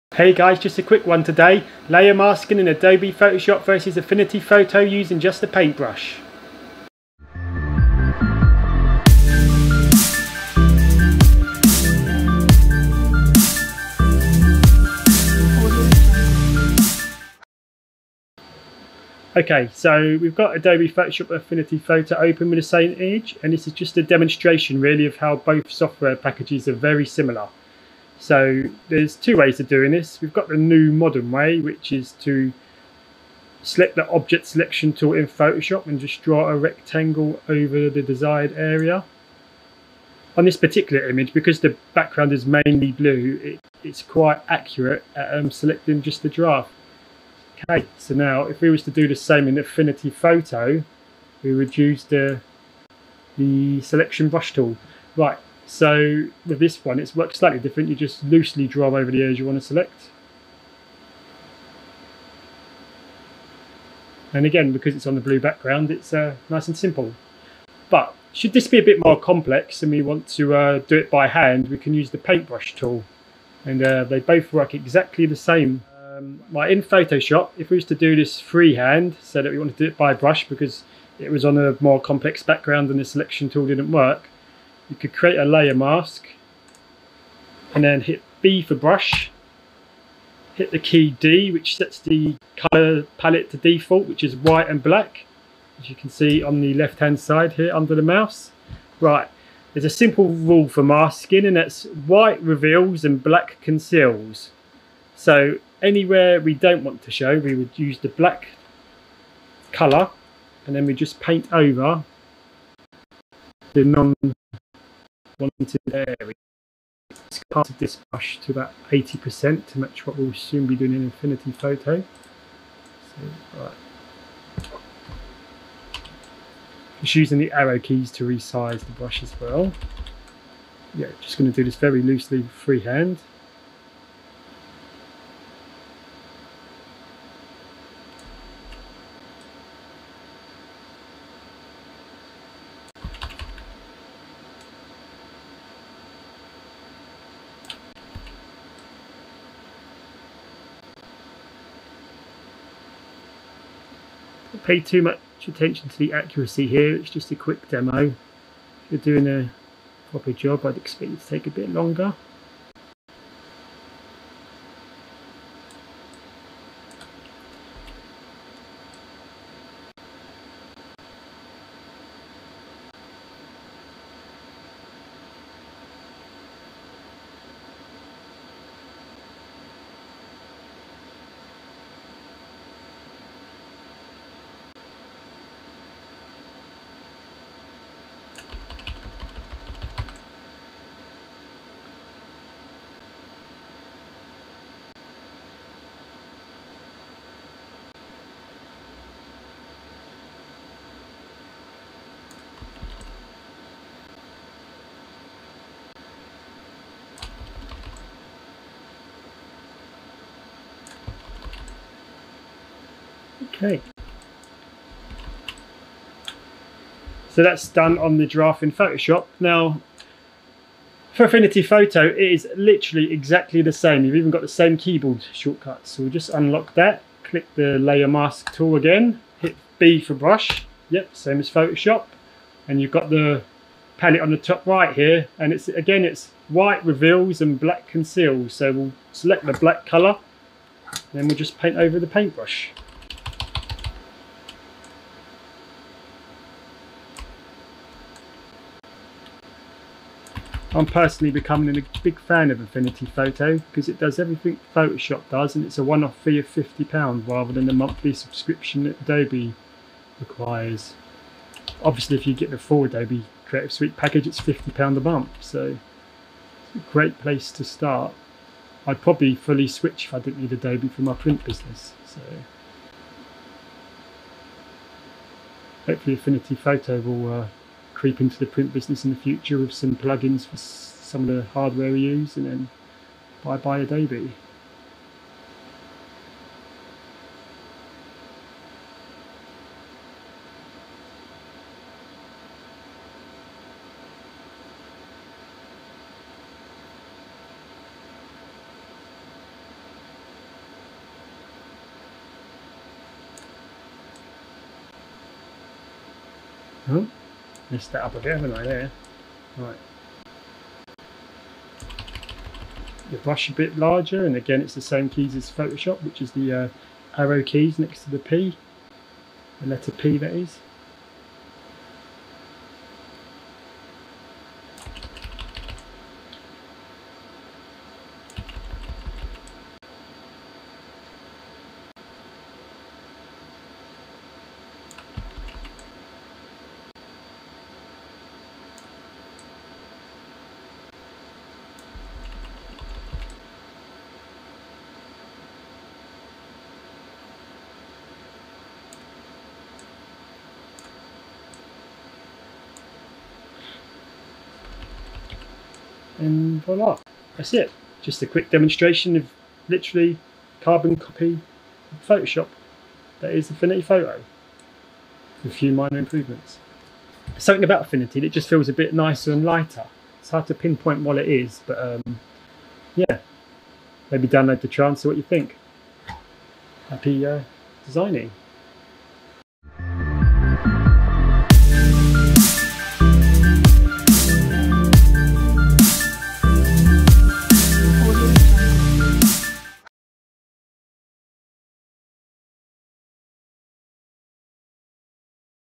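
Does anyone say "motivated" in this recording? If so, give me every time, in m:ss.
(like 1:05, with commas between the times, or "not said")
not said.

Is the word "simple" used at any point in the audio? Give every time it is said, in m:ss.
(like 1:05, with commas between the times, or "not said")
1:06, 1:39.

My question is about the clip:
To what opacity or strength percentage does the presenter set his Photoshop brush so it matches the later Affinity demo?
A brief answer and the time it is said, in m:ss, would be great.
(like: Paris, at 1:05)
80%, at 1:58.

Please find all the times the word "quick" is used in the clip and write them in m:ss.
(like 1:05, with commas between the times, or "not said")
0:00, 2:37, 5:58.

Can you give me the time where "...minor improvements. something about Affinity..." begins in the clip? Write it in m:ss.
6:05.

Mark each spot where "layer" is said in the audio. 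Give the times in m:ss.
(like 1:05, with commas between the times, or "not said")
0:01, 1:25, 3:47.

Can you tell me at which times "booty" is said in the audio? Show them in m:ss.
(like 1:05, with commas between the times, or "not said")
not said.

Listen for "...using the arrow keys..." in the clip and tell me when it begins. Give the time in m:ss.
2:07.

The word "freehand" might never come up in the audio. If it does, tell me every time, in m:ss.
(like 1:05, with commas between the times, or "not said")
1:18, 2:12.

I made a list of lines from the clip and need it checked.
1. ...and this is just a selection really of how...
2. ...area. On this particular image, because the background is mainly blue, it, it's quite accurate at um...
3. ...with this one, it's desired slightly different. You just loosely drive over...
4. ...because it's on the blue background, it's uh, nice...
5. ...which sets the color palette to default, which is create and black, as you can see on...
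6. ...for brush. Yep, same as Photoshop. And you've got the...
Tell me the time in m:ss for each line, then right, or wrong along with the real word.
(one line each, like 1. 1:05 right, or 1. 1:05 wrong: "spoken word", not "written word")
1. 0:23 wrong: "demonstration", not "selection"
2. 0:38 right
3. 0:56 wrong: "worked", not "desired"
4. 1:04 right
5. 1:31 wrong: "white", not "create"
6. 3:50 right.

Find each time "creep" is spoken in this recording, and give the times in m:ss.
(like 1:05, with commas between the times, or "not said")
4:38.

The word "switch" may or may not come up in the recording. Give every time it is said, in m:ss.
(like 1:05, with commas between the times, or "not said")
4:29.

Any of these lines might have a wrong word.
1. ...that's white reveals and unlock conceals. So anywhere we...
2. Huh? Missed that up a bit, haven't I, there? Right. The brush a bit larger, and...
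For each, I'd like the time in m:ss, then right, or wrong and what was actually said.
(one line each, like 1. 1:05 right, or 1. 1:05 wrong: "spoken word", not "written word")
1. 1:41 wrong: "black", not "unlock"
2. 5:06 right.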